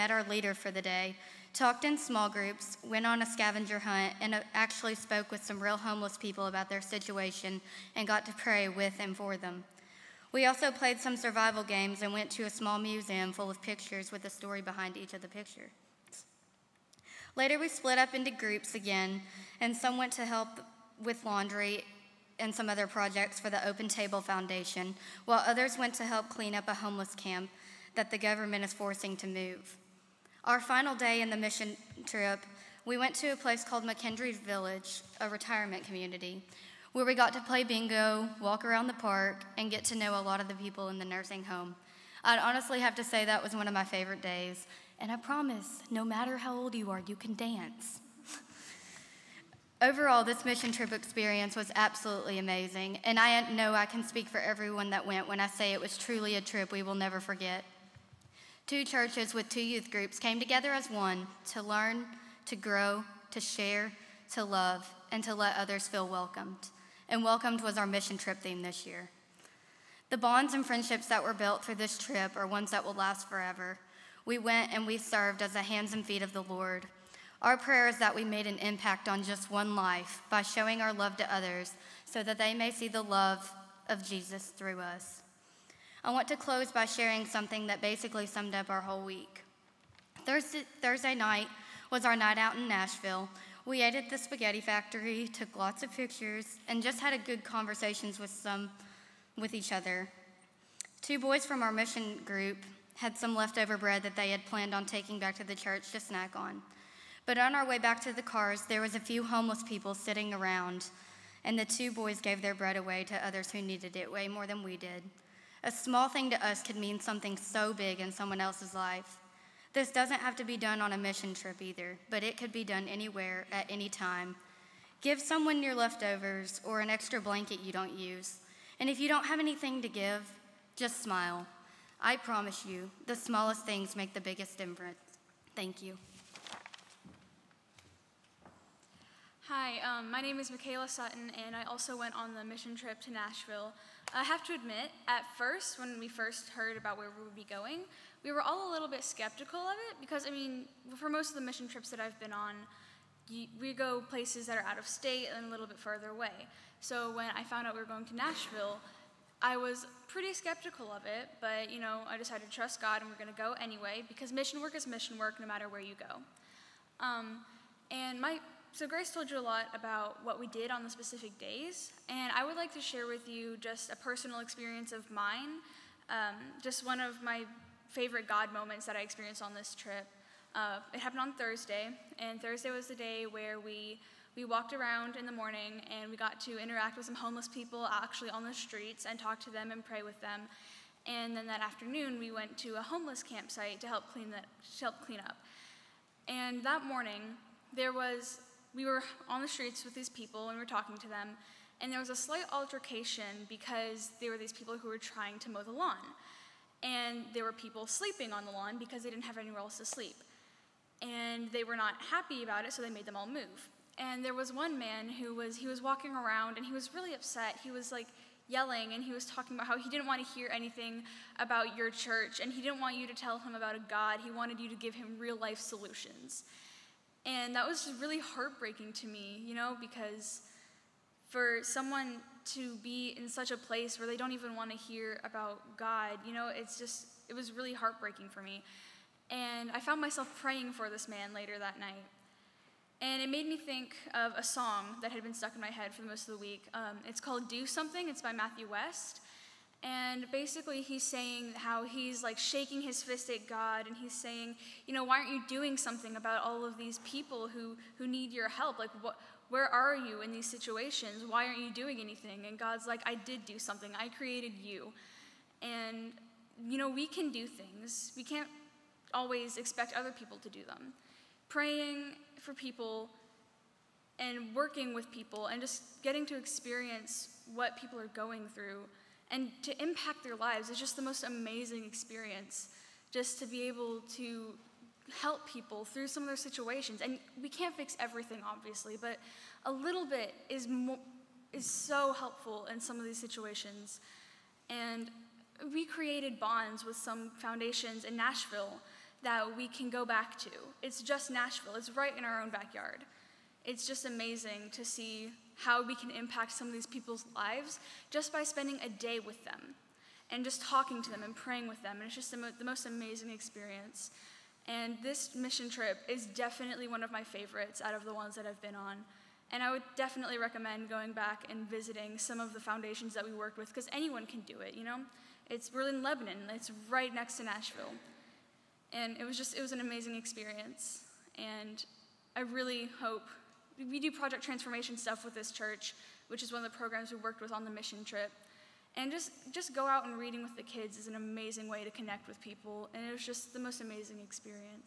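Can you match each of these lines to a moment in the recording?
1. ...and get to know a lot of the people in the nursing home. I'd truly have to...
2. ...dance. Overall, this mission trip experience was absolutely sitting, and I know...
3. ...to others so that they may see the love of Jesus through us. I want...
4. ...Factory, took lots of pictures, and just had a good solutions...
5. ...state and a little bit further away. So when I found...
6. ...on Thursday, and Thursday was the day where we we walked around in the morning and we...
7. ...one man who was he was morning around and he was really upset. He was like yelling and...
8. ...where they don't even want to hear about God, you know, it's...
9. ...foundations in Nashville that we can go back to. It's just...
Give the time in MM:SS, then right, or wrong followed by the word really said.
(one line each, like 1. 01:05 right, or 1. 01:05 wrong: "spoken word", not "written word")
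1. 00:39 wrong: "honestly", not "truly"
2. 00:47 wrong: "amazing", not "sitting"
3. 01:21 right
4. 01:34 wrong: "conversations", not "solutions"
5. 02:34 right
6. 03:01 right
7. 03:34 wrong: "walking", not "morning"
8. 03:53 right
9. 04:57 right.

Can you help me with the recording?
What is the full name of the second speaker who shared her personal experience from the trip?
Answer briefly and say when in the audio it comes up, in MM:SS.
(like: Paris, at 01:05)
Michaela Sutton, at 02:20.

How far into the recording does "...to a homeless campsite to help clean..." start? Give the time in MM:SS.
03:12.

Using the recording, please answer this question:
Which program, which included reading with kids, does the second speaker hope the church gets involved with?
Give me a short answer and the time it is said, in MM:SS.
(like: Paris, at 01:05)
Project Transformation, at 05:34.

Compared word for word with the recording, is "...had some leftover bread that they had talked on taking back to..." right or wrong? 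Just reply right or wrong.
wrong.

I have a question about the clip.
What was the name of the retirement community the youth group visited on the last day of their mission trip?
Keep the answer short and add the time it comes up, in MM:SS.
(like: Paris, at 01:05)
McKendree Village, at 00:33.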